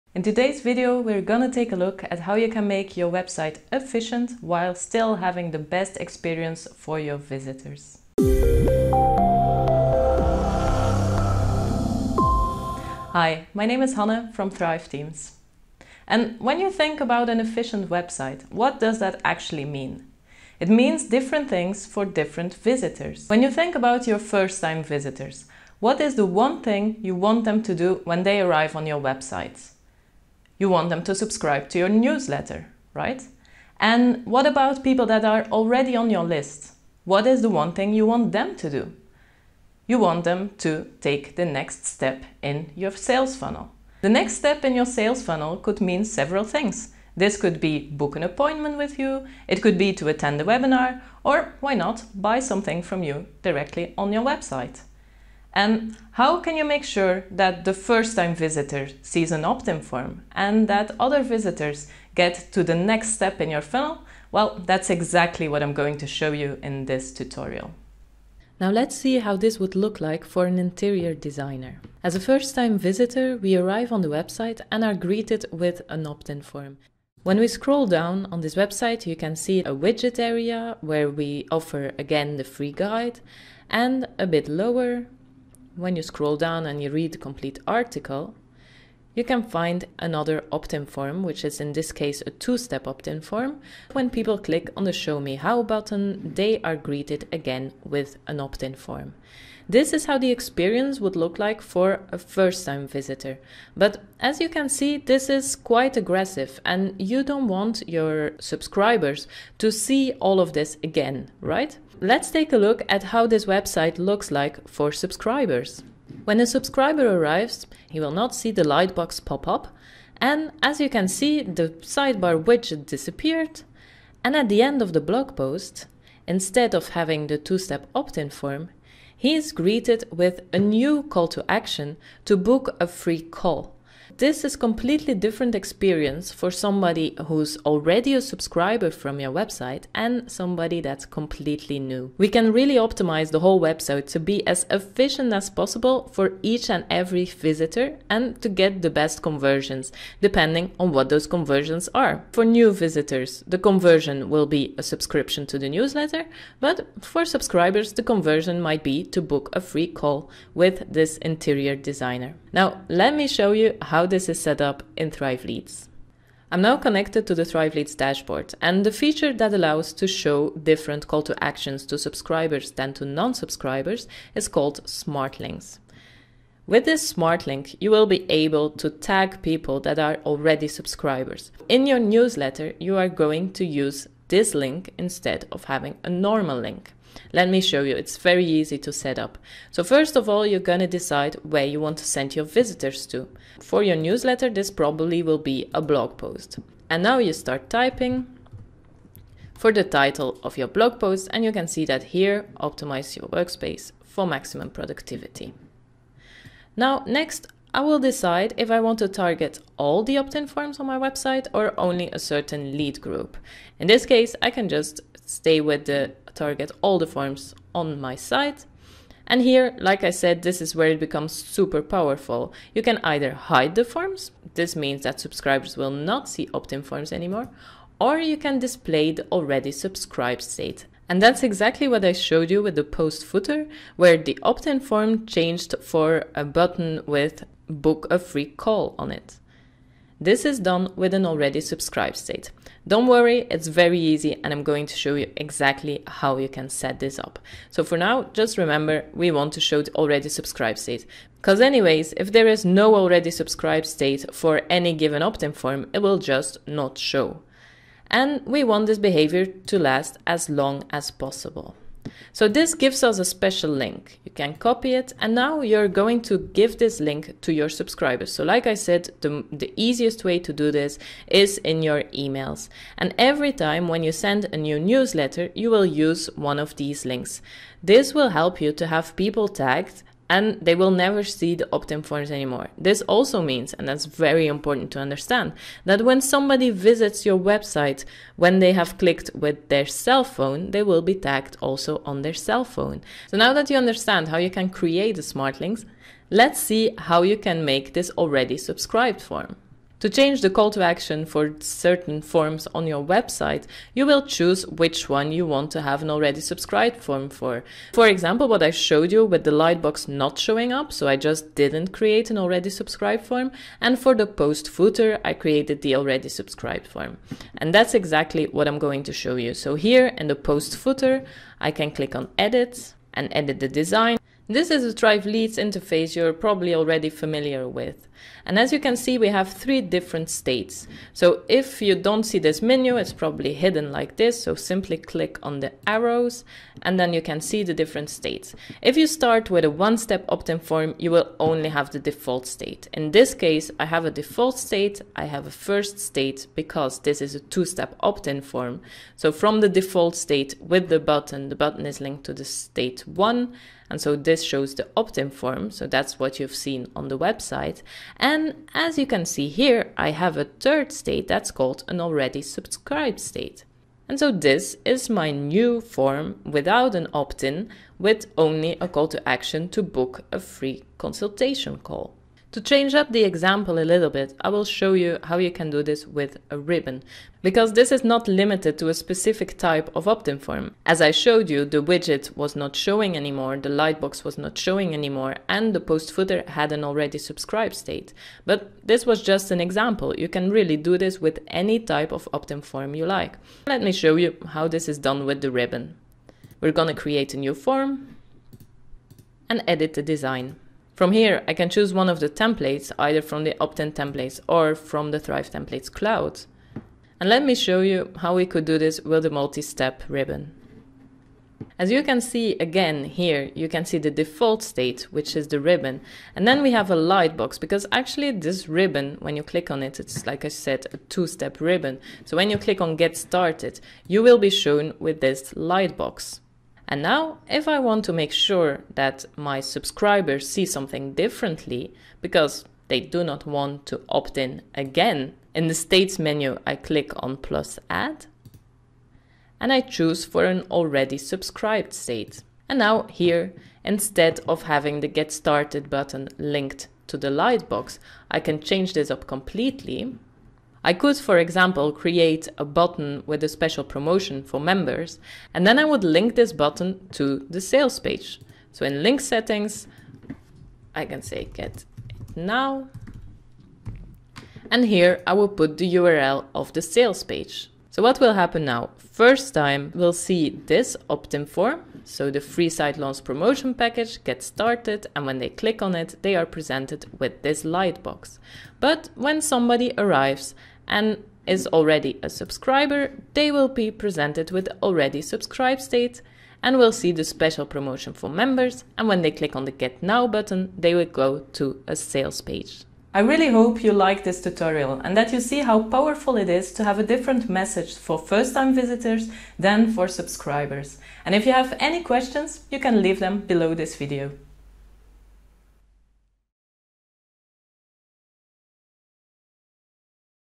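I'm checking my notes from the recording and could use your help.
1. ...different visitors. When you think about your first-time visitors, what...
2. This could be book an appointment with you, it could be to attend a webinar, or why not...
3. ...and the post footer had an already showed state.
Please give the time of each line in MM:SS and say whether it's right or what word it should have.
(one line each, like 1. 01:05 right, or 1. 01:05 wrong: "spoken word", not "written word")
1. 00:22 right
2. 00:47 right
3. 06:25 wrong: "subscribed", not "showed".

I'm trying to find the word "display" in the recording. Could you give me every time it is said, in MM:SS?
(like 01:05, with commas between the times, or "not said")
03:48.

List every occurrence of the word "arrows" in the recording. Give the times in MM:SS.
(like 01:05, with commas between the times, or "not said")
05:35.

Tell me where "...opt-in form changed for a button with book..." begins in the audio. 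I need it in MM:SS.
03:54.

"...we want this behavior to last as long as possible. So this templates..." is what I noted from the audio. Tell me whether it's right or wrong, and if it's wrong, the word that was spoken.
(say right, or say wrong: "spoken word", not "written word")
wrong: "gives", not "templates".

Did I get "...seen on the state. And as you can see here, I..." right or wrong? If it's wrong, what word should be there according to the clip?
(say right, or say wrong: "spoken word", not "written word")
wrong: "website", not "state".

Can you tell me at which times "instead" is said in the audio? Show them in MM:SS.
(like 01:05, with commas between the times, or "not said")
02:06, 03:04, 07:23.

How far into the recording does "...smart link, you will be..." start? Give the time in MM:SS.
02:57.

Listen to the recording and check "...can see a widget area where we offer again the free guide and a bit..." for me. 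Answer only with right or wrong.
right.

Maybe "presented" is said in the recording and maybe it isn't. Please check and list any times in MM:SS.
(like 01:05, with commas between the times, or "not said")
07:56, 08:03.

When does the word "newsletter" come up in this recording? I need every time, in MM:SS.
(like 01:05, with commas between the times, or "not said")
00:31, 02:35, 03:01, 03:13, 04:34.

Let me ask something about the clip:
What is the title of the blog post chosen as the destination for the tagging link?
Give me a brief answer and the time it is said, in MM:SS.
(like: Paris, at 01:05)
Optimize your workspace for maximum productivity, at 03:22.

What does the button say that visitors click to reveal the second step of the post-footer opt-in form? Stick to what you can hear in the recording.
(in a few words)
Show Me How.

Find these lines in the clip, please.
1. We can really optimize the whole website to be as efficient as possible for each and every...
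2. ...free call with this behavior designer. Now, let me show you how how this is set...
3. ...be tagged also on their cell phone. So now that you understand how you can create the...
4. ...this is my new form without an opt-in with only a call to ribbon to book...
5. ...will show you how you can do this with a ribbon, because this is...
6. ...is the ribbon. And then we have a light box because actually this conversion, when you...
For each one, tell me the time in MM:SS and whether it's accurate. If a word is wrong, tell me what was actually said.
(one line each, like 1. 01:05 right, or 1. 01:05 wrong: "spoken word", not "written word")
1. 02:22 right
2. 02:39 wrong: "interior", not "behavior"
3. 04:51 right
4. 06:04 wrong: "action", not "ribbon"
5. 06:14 right
6. 06:55 wrong: "ribbon", not "conversion".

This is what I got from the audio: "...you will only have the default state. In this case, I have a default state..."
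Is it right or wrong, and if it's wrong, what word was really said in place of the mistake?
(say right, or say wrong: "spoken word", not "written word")
right.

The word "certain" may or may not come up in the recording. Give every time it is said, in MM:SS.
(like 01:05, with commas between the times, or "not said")
03:32, 05:01.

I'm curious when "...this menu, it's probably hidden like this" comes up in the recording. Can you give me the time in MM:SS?
05:32.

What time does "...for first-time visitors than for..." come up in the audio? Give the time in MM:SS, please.
08:17.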